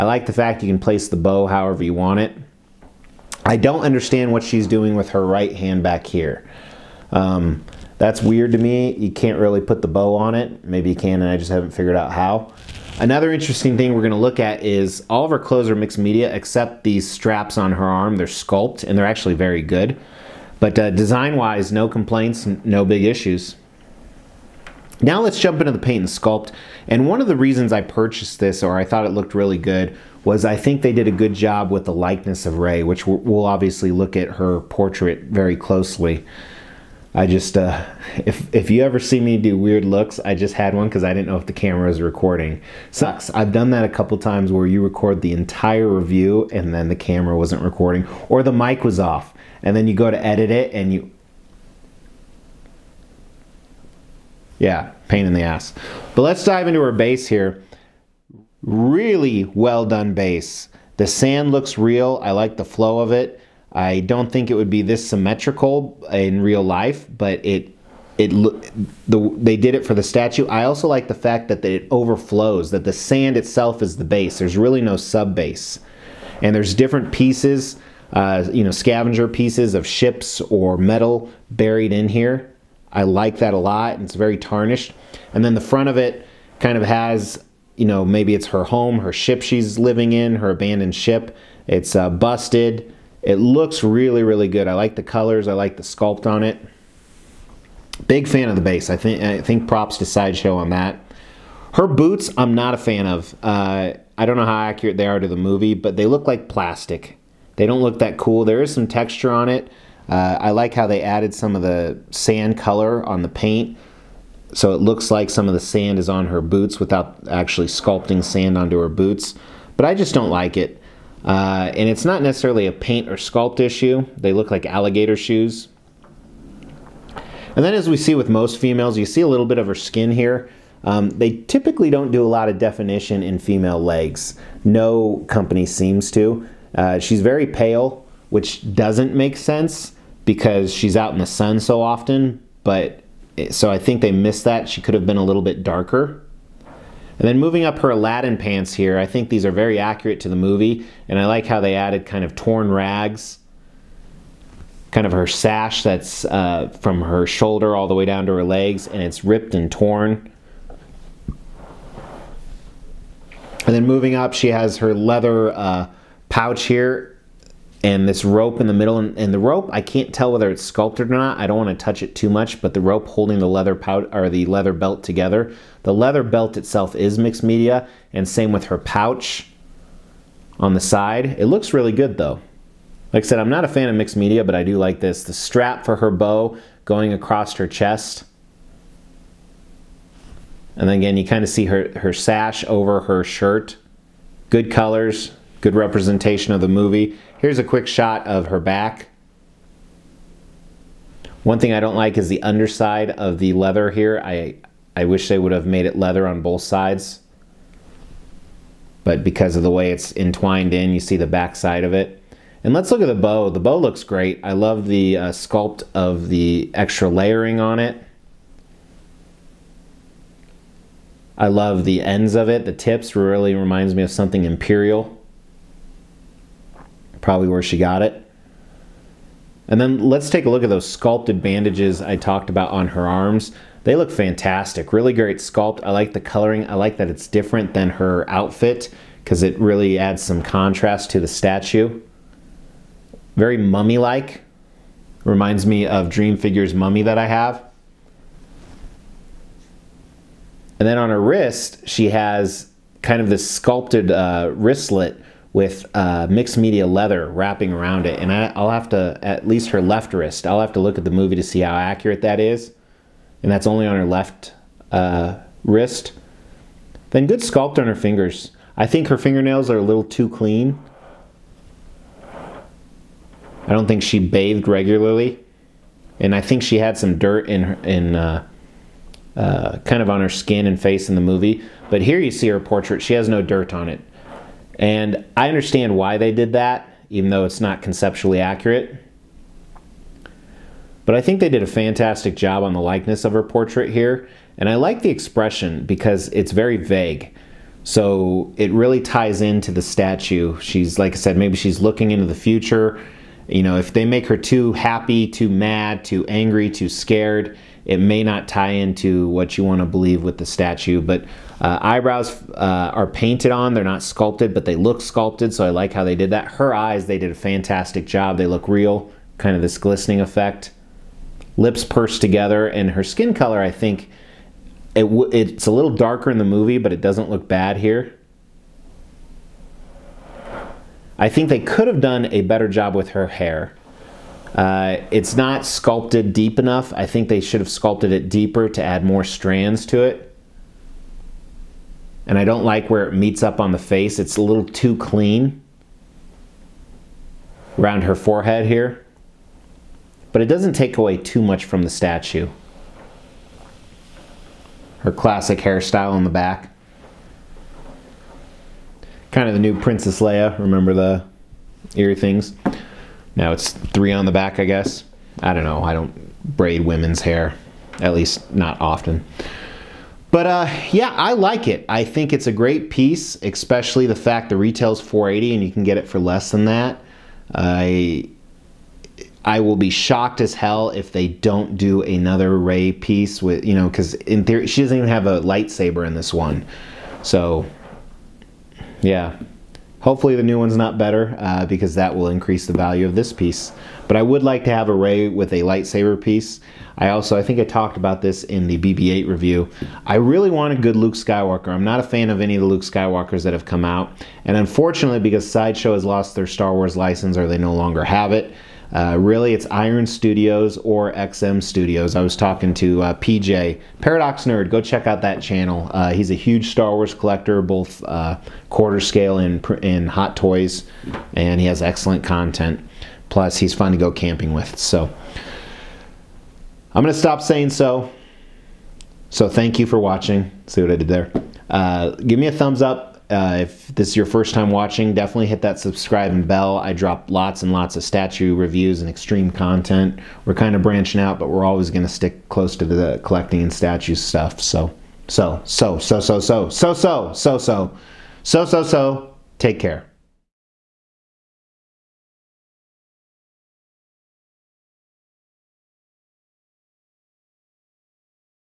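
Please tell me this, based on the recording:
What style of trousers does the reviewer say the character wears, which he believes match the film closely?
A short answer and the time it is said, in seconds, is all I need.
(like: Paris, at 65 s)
Aladdin pants, at 147 s.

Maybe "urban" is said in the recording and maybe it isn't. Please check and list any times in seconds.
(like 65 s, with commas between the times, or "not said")
not said.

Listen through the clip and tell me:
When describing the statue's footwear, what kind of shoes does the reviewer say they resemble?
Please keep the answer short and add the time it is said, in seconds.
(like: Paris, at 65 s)
Alligator shoes, at 124 s.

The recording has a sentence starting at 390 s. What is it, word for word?
Hopefully the new one's not better uh, because that will increase the value of this piece.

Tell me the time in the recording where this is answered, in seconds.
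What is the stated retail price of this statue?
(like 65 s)
375 s.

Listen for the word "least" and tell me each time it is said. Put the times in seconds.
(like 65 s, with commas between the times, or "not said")
259 s, 368 s.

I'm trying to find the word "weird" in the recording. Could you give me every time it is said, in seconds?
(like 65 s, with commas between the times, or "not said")
8 s, 39 s.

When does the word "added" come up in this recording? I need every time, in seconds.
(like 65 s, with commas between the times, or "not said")
111 s, 151 s.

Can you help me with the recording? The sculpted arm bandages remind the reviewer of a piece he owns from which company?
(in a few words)
Dream Figures.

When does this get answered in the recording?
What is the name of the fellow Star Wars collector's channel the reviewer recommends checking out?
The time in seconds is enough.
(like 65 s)
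414 s.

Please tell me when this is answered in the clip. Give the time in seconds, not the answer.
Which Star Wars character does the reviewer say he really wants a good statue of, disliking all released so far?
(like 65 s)
400 s.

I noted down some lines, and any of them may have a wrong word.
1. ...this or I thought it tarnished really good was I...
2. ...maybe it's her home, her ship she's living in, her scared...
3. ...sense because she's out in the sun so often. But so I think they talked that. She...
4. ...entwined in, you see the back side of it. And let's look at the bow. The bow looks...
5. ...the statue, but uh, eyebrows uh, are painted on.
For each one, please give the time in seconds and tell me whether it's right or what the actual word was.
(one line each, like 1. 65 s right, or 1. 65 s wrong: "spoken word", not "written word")
1. 28 s wrong: "looked", not "tarnished"
2. 88 s wrong: "abandoned", not "scared"
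3. 139 s wrong: "missed", not "talked"
4. 210 s right
5. 310 s right.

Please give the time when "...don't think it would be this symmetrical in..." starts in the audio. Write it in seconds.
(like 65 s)
64 s.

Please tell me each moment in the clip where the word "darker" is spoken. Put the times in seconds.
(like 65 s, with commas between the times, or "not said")
145 s, 325 s.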